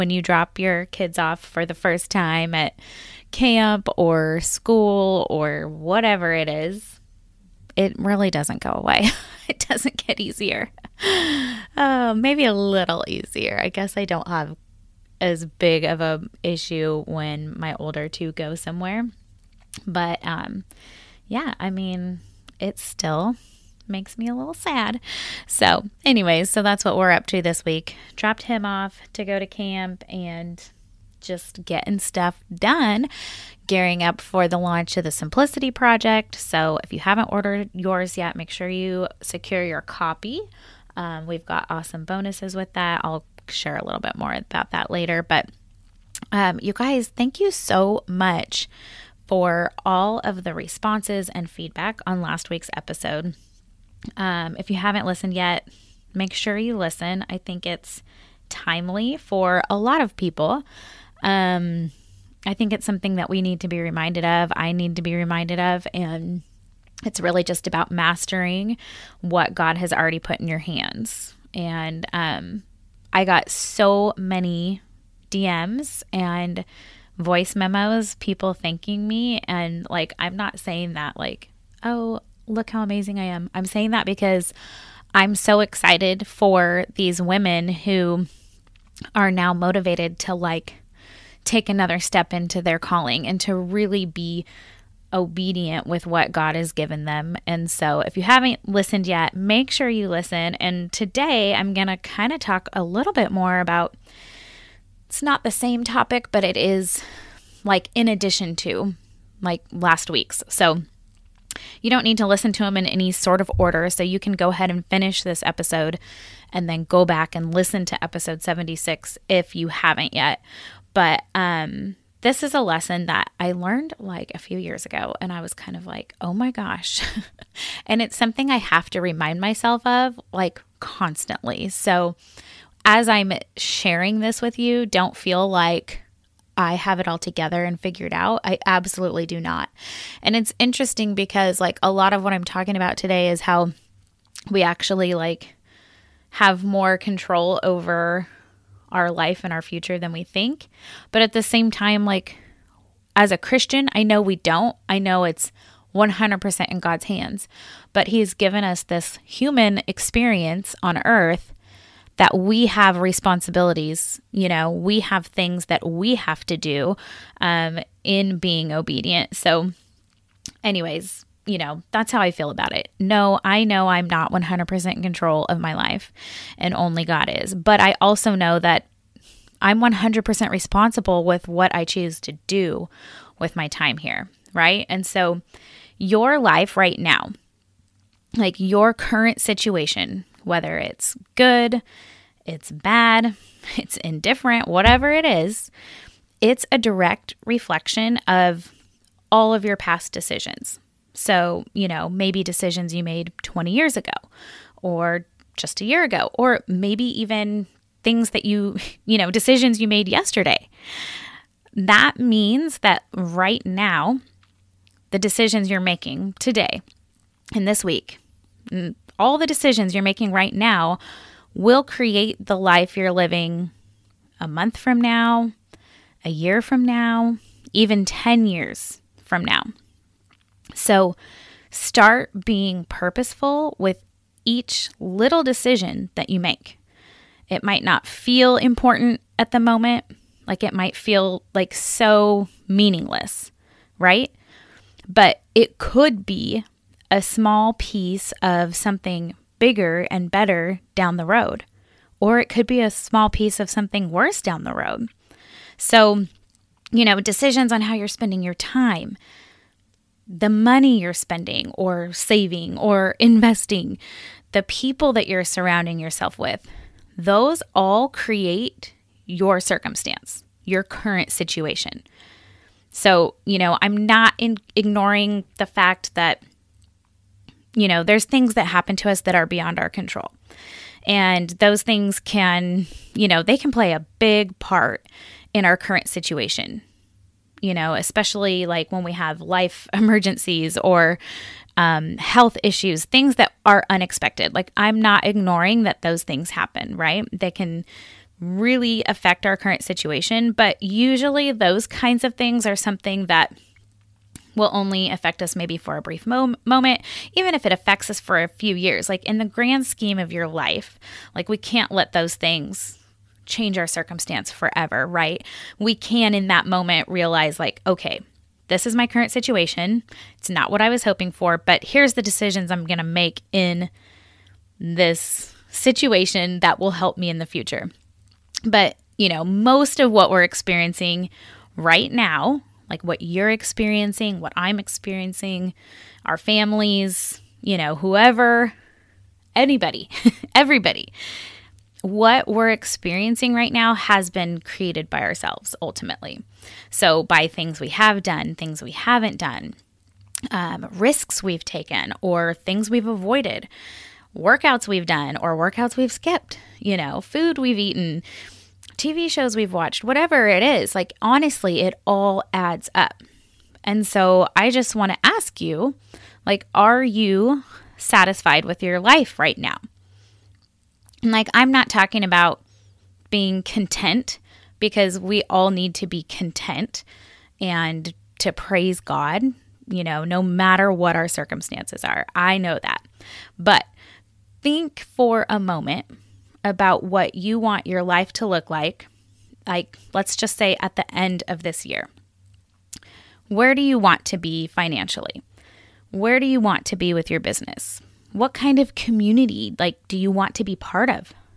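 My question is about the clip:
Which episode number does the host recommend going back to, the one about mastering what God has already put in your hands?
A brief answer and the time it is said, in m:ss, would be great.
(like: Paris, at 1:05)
76, at 1:58.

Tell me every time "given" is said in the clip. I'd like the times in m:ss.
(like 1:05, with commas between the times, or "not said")
1:36, 2:38.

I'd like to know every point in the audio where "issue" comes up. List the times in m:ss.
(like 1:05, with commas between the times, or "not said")
0:16, 4:52.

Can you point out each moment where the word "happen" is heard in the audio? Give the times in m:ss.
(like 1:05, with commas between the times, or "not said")
4:38, 4:56.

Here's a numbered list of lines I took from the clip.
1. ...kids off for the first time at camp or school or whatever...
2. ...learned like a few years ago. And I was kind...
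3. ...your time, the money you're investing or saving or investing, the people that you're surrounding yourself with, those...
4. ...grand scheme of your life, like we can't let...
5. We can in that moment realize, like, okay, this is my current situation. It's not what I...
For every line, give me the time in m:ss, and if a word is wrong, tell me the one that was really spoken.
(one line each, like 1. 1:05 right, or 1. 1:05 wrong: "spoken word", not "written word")
1. 0:00 right
2. 2:03 right
3. 4:18 wrong: "spending", not "investing"
4. 5:09 right
5. 5:15 right.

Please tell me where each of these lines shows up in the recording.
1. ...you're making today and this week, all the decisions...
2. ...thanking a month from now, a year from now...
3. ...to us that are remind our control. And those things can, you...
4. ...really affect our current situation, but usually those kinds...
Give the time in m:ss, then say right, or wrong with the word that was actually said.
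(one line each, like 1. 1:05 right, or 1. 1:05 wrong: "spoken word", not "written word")
1. 3:35 right
2. 3:43 wrong: "living", not "thanking"
3. 4:38 wrong: "beyond", not "remind"
4. 4:58 right.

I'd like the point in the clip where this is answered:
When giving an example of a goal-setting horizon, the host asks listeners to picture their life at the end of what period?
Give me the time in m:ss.
6:31.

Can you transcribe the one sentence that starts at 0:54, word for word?
Um, if you haven't listened yet, make sure you listen.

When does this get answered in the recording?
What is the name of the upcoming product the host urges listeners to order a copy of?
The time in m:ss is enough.
0:35.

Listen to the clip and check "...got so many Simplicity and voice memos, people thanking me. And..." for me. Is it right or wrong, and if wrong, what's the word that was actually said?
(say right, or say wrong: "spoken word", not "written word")
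wrong: "DMs", not "Simplicity".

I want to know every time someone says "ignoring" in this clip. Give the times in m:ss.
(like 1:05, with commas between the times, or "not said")
4:34, 4:55.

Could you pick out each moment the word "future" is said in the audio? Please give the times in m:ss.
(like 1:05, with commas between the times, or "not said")
2:29, 5:27.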